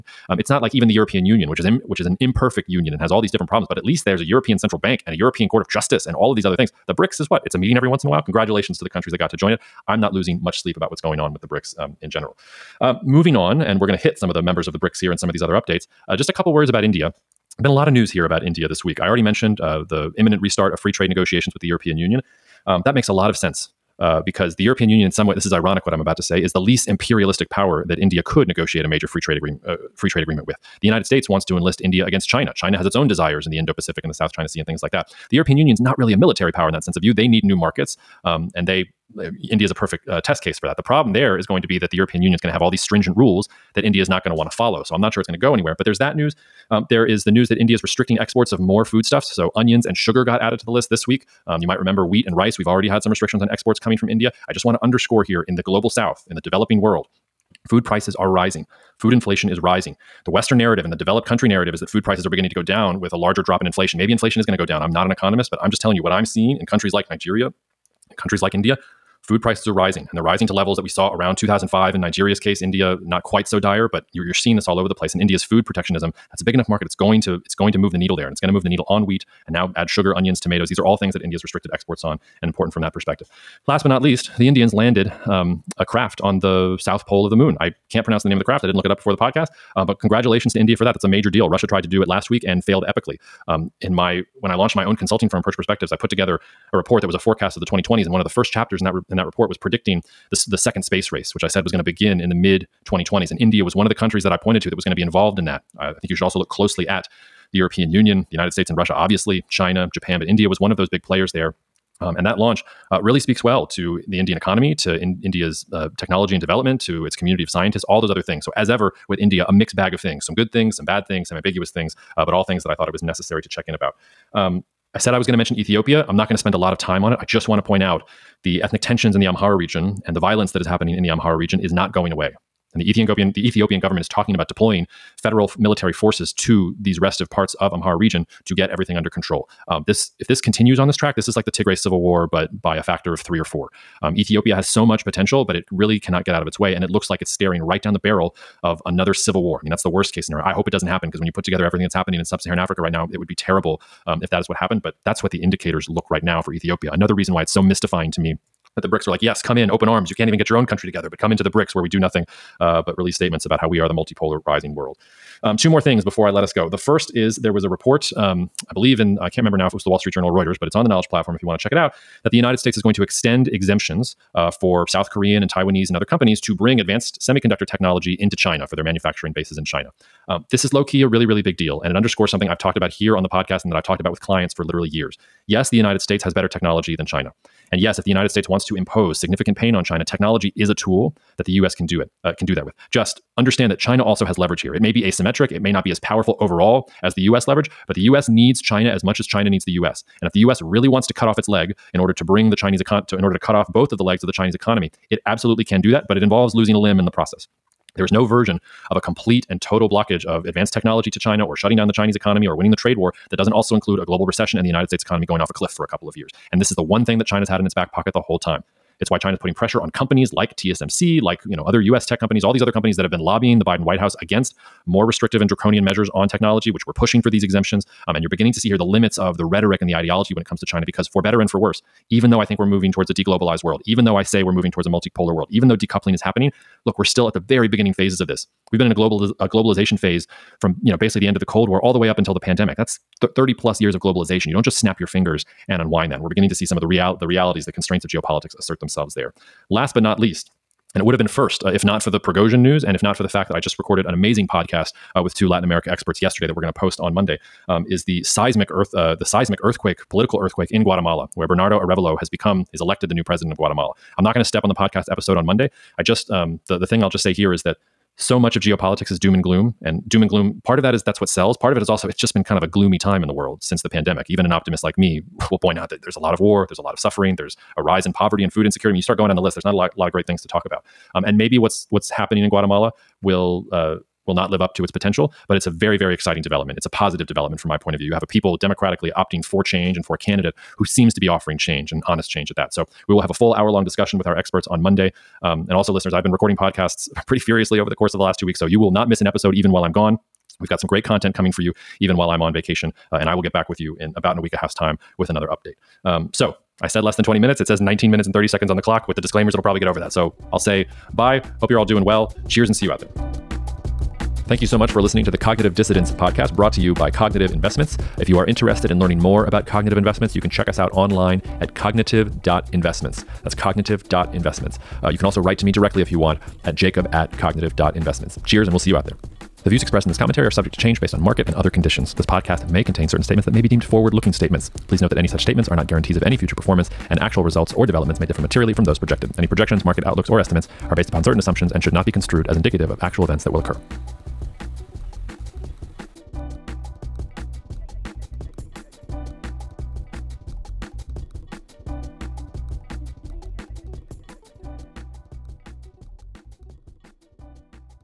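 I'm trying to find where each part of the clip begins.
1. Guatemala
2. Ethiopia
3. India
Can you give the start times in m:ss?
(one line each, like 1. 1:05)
1. 2:45
2. 2:05
3. 0:11.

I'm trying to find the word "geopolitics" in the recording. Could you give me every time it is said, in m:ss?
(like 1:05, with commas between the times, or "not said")
4:08, 4:28.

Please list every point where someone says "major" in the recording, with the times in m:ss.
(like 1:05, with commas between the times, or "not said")
0:28, 1:31.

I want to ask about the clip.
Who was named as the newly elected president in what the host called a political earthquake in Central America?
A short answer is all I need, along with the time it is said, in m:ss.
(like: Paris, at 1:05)
Bernardo Arevalo, at 4:21.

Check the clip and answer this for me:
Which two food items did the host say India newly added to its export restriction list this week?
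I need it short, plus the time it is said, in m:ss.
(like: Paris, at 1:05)
onions and sugar, at 0:49.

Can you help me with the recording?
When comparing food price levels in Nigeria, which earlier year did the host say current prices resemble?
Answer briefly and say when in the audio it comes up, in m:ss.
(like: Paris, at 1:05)
2005, at 1:11.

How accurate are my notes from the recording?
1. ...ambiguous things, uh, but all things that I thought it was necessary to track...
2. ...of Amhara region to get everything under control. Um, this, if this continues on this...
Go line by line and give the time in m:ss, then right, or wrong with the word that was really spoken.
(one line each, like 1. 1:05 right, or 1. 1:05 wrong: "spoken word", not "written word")
1. 2:01 wrong: "check", not "track"
2. 2:17 right.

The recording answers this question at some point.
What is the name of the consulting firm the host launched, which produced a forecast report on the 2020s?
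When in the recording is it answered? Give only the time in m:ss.
1:35.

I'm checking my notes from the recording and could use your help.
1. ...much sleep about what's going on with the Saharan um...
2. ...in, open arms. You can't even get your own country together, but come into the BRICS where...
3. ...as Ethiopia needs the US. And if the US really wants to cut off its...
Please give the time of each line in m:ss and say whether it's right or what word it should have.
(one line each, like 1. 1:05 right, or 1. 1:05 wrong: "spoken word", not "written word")
1. 0:10 wrong: "BRICS", not "Saharan"
2. 2:39 right
3. 3:19 wrong: "China", not "Ethiopia".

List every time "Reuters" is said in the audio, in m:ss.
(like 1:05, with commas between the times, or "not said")
2:50.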